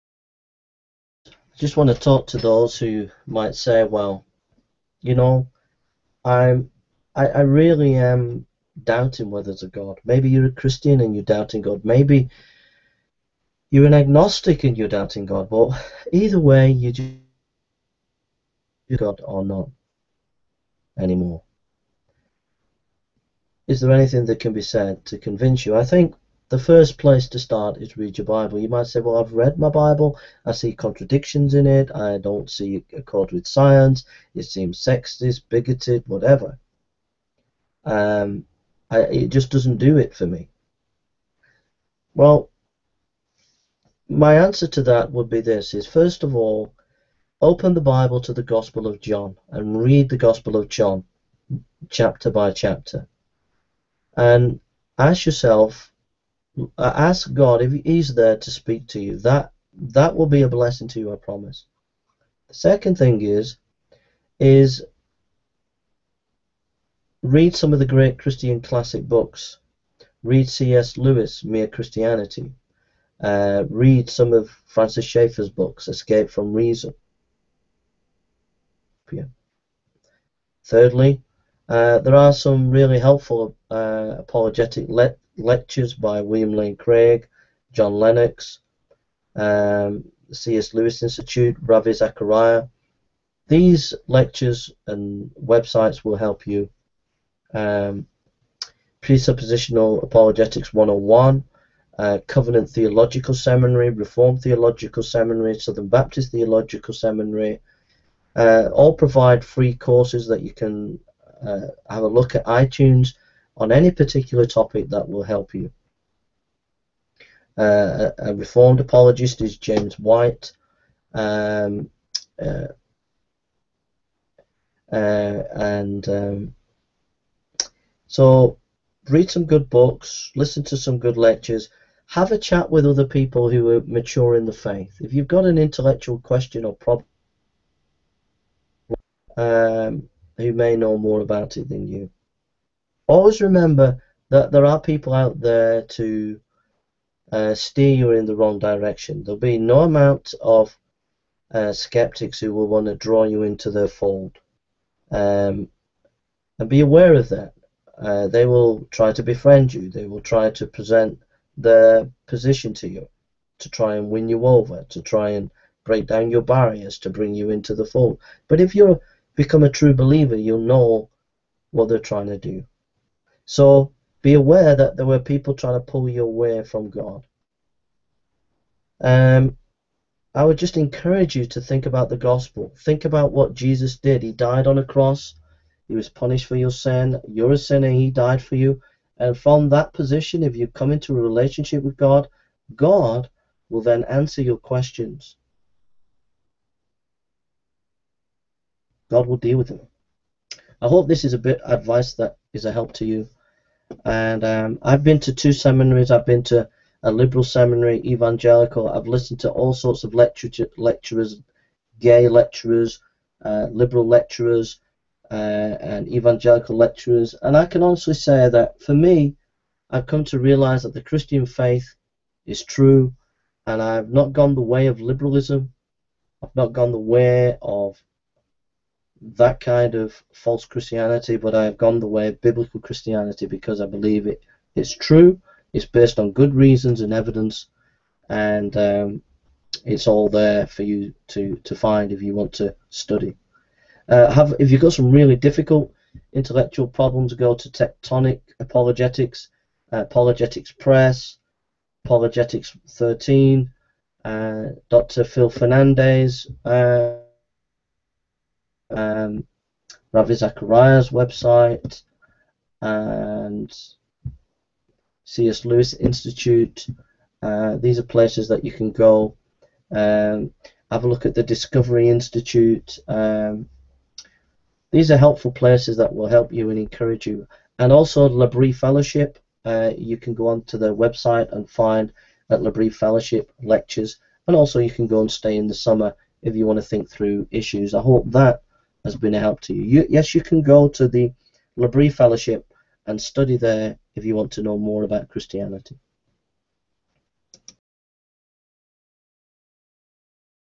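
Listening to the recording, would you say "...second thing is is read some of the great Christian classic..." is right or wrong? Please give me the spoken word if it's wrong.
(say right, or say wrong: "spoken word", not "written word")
right.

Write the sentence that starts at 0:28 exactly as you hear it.
You might say, well, I've read my Bible.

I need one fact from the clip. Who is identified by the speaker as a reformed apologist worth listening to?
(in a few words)
James White.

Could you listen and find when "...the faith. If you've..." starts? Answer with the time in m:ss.
2:14.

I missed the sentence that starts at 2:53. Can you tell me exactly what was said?
So be aware that there were people trying to pull you away from God.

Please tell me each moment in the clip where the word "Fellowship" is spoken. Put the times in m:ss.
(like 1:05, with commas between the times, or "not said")
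4:38, 4:42, 4:52.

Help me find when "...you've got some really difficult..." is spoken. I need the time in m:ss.
4:04.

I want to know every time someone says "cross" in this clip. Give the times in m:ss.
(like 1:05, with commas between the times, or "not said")
3:04.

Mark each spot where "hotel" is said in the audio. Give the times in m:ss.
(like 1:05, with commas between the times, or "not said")
not said.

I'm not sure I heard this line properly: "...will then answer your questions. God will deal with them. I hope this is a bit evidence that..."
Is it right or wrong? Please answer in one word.
wrong.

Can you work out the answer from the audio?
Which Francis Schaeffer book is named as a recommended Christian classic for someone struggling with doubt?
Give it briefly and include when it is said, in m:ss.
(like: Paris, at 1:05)
Escape from Reason, at 1:15.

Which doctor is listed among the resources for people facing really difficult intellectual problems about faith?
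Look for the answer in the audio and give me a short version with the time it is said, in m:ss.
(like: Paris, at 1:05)
Dr. Phil Fernandes, at 4:14.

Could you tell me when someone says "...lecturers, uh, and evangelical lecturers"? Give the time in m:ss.
3:34.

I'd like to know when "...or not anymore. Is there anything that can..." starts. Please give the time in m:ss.
0:19.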